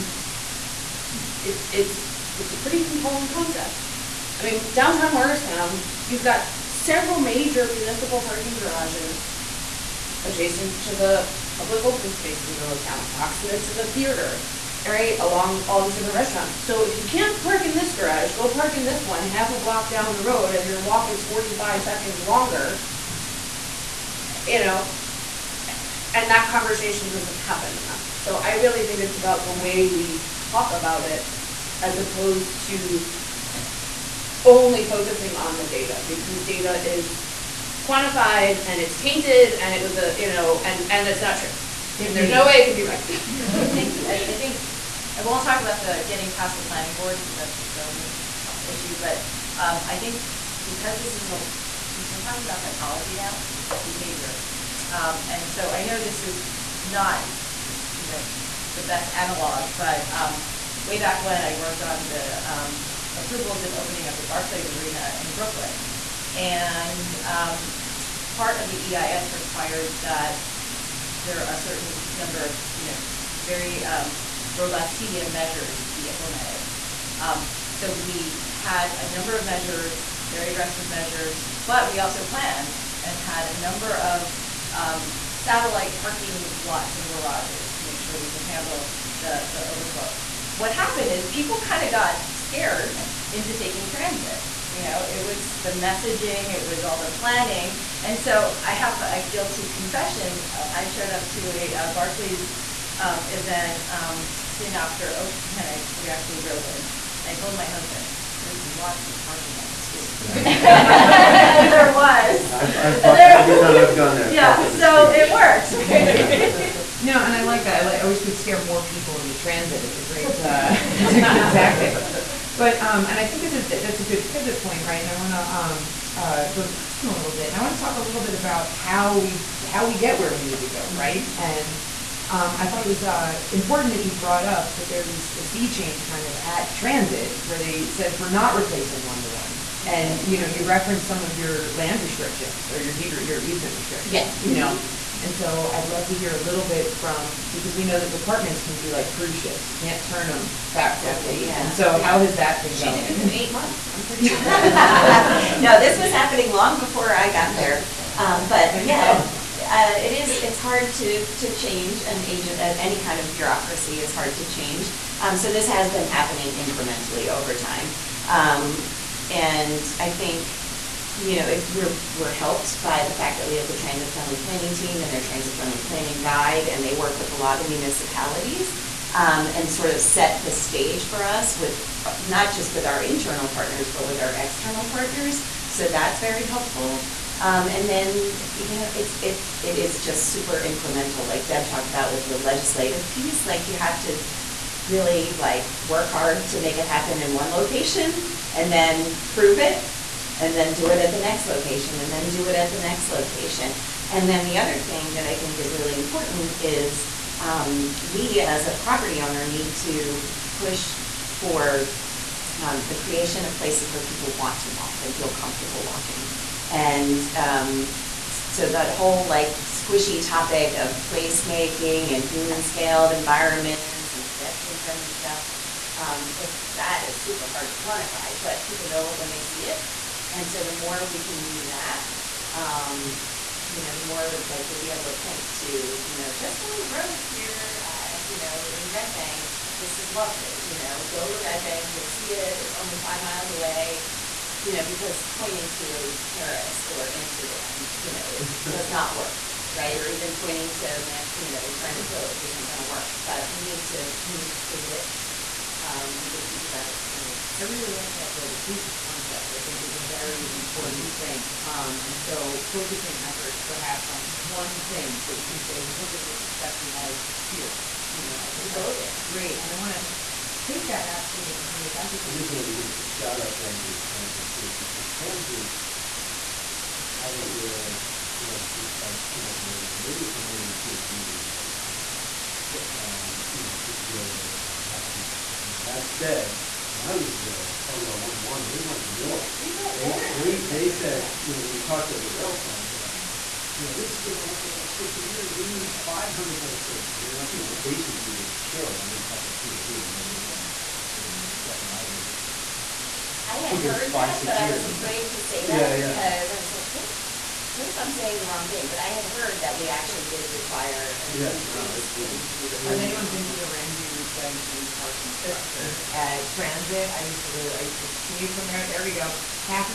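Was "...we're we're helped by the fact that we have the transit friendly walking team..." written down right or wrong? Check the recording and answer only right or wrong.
wrong.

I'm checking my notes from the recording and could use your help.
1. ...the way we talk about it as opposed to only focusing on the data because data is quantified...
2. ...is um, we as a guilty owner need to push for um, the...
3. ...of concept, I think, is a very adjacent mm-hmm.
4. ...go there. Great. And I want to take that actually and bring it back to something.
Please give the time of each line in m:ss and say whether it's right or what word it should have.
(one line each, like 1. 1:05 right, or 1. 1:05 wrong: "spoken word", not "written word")
1. 0:29 right
2. 3:26 wrong: "property", not "guilty"
3. 4:18 wrong: "important", not "adjacent"
4. 4:28 right.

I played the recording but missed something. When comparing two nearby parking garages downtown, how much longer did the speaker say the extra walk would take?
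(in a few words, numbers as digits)
45 seconds.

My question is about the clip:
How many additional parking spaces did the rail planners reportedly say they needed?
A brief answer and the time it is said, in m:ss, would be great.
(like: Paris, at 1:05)
500, at 4:56.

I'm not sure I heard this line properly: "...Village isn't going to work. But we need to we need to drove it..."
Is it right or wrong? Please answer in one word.
wrong.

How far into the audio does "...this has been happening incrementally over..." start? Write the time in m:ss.
2:45.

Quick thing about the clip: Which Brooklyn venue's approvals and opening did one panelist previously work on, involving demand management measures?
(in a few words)
Barclays Arena.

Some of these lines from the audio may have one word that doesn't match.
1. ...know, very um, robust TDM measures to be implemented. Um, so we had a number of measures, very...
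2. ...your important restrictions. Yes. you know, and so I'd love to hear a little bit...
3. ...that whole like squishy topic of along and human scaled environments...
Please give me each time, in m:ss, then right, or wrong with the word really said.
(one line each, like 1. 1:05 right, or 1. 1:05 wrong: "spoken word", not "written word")
1. 1:12 right
2. 2:23 wrong: "easement", not "important"
3. 3:38 wrong: "placemaking", not "along".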